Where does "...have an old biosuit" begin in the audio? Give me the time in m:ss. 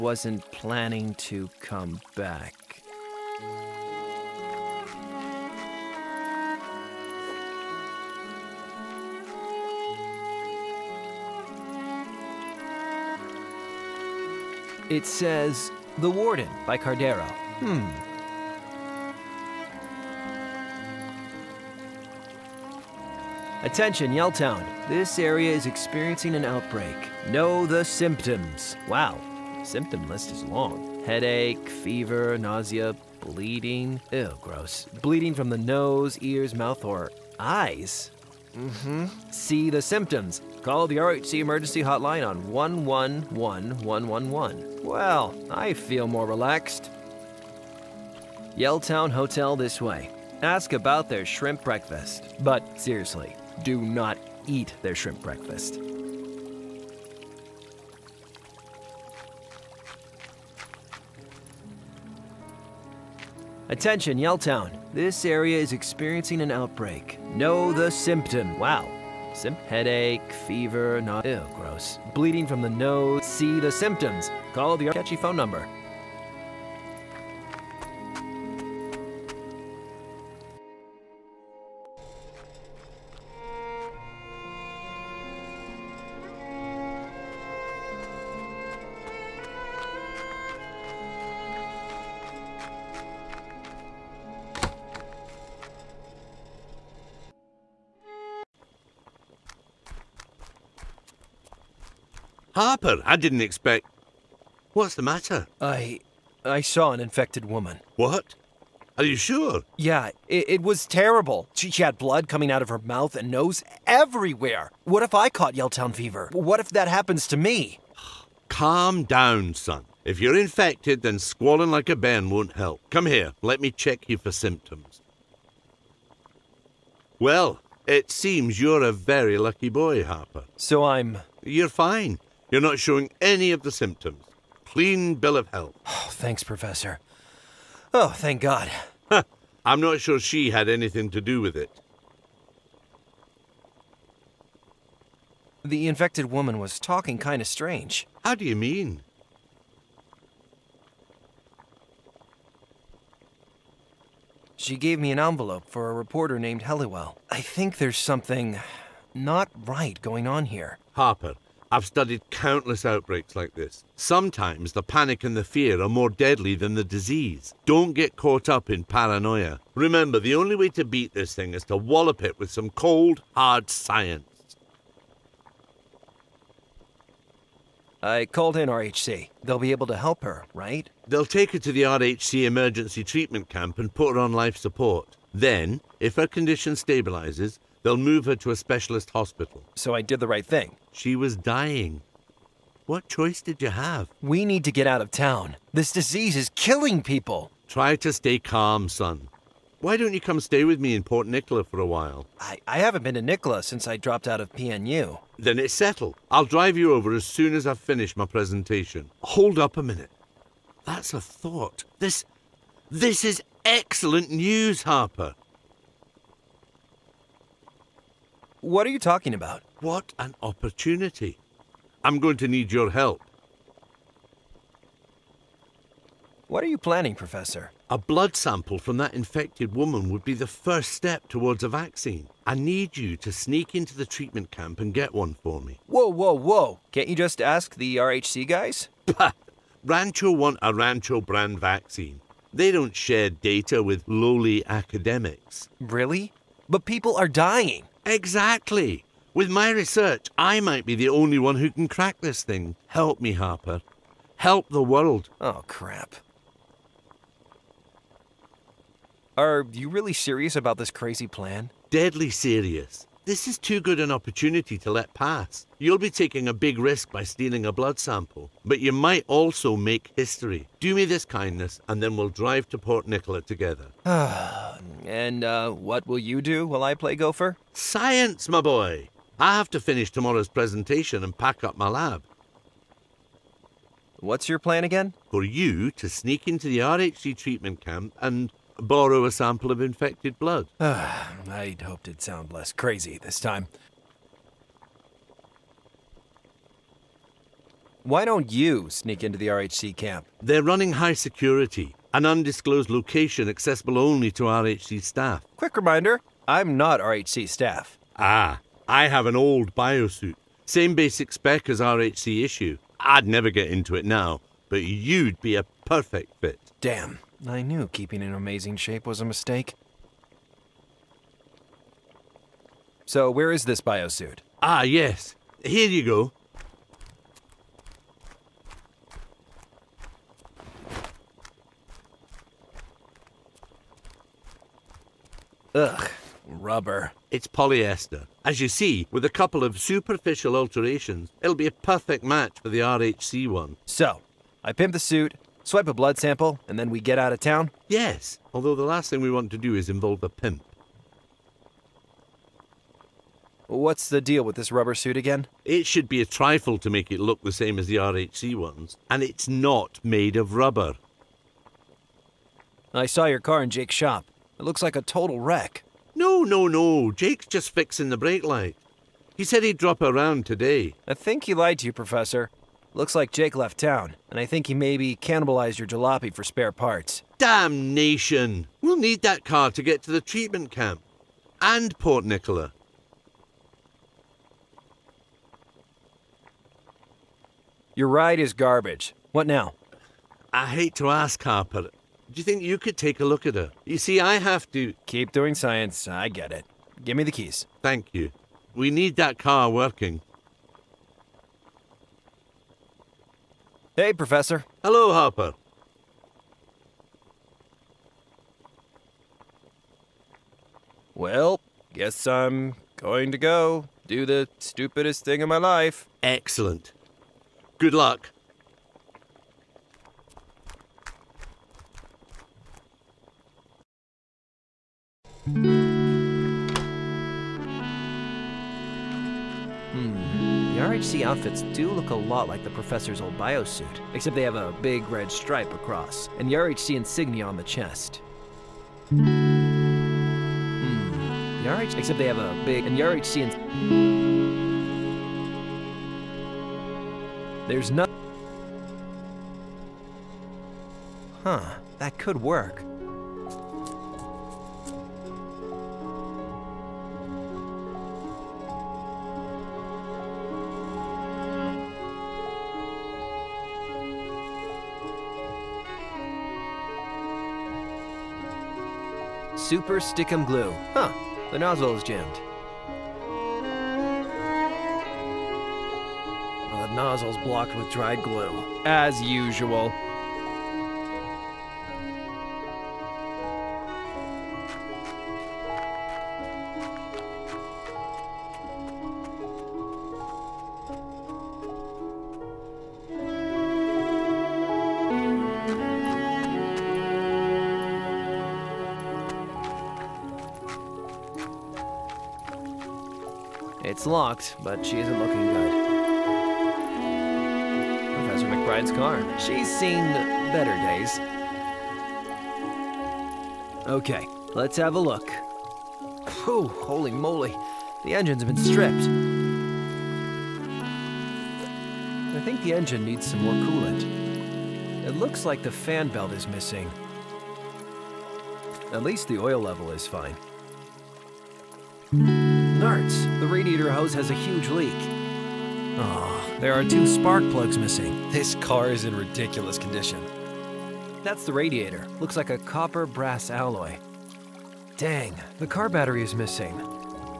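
5:09.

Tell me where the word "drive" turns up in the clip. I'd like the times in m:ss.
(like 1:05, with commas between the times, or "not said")
3:26, 4:32.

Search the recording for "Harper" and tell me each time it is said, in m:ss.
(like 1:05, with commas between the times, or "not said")
1:42, 2:10, 2:40, 3:34, 4:13, 6:31, 6:45.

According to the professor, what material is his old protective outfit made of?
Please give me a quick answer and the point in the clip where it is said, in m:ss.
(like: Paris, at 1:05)
Polyester, at 5:37.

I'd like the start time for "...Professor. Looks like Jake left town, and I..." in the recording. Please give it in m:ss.
6:11.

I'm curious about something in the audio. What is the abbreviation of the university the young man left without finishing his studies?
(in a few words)
PNU.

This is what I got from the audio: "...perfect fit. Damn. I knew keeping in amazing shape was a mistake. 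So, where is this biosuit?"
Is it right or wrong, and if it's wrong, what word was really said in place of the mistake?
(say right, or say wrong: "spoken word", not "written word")
right.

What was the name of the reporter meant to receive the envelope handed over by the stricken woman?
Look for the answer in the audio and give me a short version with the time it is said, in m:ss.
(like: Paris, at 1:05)
Helliwell, at 2:36.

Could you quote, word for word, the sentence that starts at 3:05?
Then, if her condition stabilizes, They'll move her to a specialist hospital.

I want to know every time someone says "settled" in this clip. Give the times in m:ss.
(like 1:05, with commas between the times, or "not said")
3:25.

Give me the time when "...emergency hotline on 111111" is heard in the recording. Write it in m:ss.
0:41.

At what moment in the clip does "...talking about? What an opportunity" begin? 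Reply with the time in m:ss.
3:38.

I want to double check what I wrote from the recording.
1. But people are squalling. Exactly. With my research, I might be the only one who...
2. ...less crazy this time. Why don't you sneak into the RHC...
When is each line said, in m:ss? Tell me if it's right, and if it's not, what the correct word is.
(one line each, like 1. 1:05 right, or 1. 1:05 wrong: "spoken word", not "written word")
1. 4:06 wrong: "dying", not "squalling"
2. 4:52 right.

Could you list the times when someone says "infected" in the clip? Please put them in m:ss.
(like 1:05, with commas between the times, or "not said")
1:47, 2:00, 2:25, 3:49, 4:49.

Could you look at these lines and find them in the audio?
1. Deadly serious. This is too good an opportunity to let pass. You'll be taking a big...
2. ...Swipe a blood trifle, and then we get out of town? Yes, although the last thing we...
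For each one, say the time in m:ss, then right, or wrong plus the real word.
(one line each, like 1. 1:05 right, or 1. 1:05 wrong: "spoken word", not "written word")
1. 4:21 right
2. 5:45 wrong: "sample", not "trifle".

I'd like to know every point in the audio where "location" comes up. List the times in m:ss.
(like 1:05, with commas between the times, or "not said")
5:02.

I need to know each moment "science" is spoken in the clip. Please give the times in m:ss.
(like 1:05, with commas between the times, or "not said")
2:53, 4:37, 6:35.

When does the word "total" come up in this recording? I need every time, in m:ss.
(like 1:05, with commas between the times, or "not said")
6:05.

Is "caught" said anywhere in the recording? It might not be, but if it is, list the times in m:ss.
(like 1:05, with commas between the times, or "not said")
1:55, 2:48.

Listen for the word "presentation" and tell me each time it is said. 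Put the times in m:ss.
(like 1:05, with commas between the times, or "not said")
3:28, 4:40.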